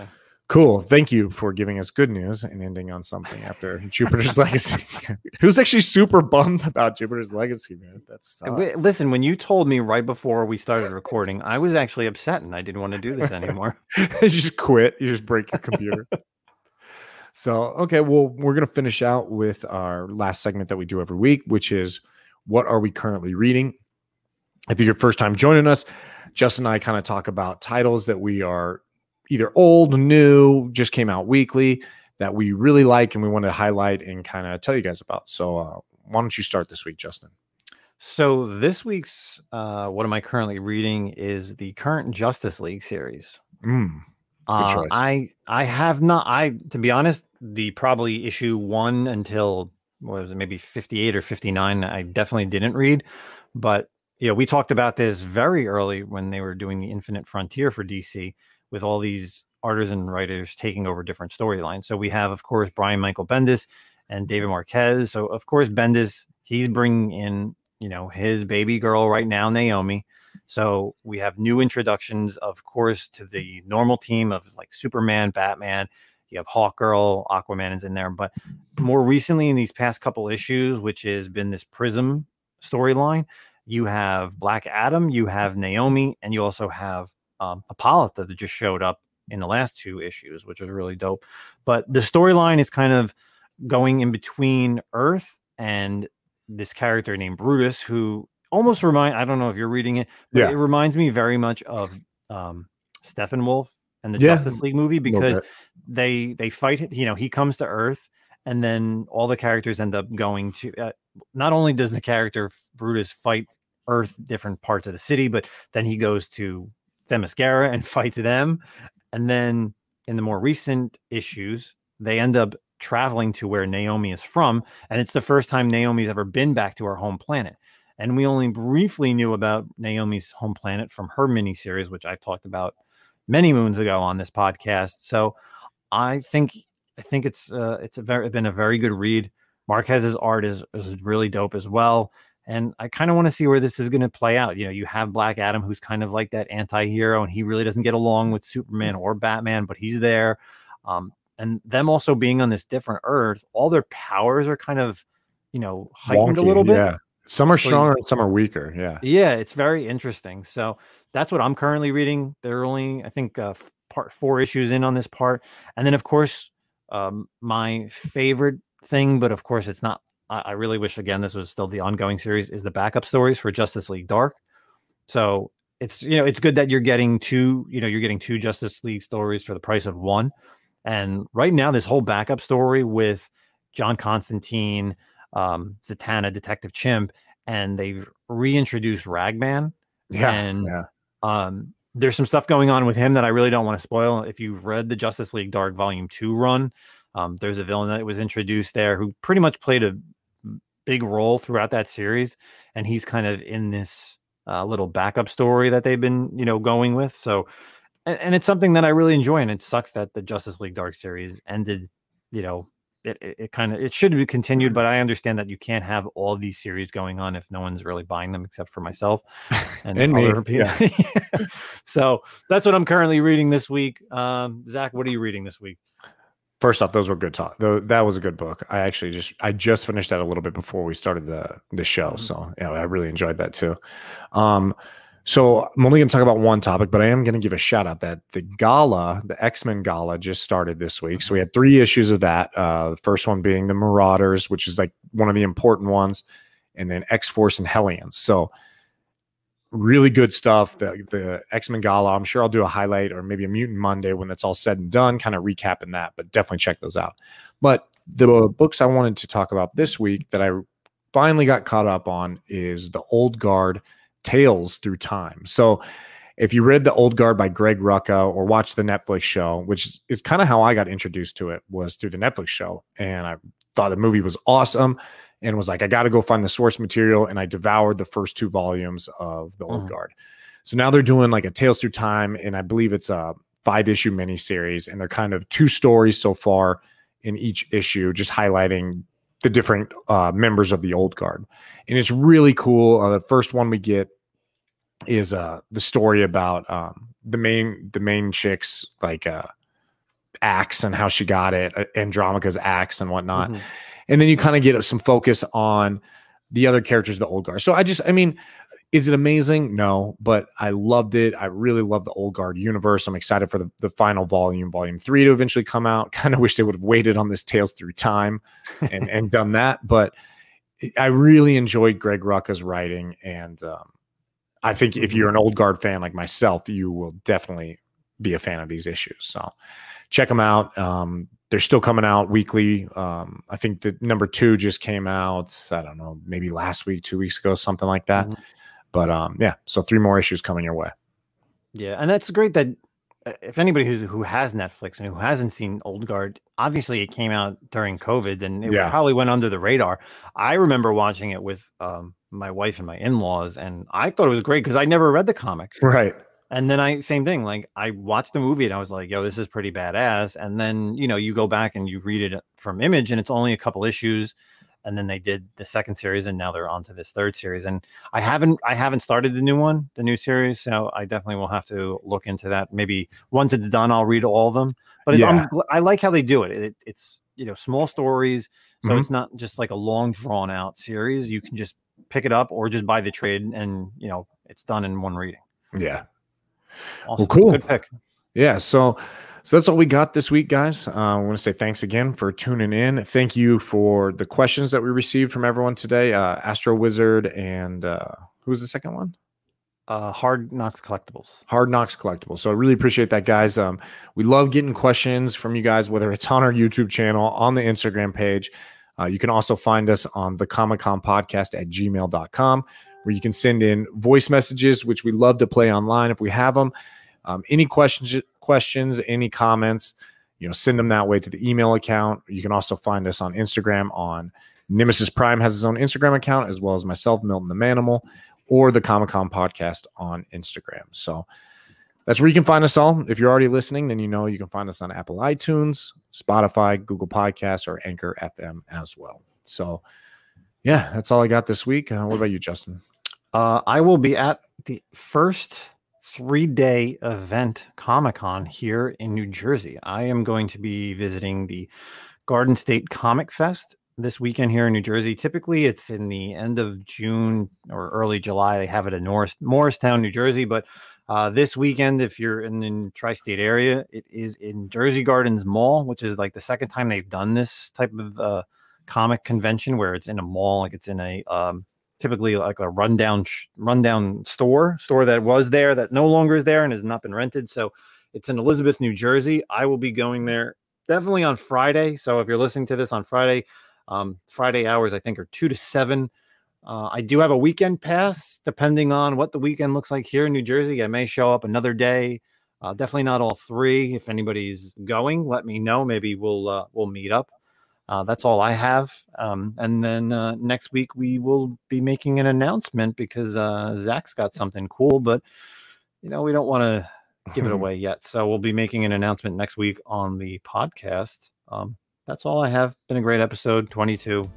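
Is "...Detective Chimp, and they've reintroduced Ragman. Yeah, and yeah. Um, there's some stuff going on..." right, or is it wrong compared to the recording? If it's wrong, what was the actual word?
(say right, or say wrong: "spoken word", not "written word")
right.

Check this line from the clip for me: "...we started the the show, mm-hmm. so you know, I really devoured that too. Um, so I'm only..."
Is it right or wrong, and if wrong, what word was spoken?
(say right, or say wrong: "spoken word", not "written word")
wrong: "enjoyed", not "devoured".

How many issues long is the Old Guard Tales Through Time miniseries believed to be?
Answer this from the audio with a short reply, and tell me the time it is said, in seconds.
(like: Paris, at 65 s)
5, at 283 s.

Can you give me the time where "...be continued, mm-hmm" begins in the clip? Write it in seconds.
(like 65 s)
214 s.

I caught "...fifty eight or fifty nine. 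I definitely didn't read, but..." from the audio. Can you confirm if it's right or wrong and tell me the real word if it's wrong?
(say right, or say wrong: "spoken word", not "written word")
right.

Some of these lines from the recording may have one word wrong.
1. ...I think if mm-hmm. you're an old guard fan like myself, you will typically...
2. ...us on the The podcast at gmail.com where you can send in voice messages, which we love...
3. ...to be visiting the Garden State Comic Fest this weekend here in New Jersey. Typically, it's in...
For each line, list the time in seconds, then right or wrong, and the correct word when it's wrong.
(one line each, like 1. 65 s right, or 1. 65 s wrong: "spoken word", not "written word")
1. 324 s wrong: "definitely", not "typically"
2. 409 s wrong: "ComiCom", not "The"
3. 450 s right.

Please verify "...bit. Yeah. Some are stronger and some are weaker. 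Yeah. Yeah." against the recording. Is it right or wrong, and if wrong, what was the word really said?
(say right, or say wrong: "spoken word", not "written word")
right.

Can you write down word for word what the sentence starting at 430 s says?
So that's where you can find us all.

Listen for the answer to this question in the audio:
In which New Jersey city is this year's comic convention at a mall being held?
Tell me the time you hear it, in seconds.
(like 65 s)
478 s.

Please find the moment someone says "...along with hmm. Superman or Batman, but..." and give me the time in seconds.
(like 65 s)
147 s.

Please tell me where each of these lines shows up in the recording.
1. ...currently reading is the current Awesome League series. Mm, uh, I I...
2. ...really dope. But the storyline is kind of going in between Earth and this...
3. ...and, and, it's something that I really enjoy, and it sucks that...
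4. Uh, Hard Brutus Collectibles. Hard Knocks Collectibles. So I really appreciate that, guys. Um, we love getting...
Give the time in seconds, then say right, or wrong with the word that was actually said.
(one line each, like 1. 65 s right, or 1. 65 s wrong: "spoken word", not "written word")
1. 40 s wrong: "Justice", not "Awesome"
2. 90 s right
3. 208 s right
4. 399 s wrong: "Knocks", not "Brutus".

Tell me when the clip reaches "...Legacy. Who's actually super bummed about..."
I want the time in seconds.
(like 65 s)
4 s.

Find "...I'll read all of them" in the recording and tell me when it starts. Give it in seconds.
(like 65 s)
373 s.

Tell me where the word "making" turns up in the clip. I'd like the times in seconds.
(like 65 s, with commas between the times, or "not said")
501 s, 508 s.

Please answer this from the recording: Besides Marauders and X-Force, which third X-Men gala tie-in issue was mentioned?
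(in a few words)
Hellions.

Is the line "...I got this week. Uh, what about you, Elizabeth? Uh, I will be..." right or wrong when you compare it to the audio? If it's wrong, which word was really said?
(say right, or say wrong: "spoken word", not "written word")
wrong: "Justin", not "Elizabeth".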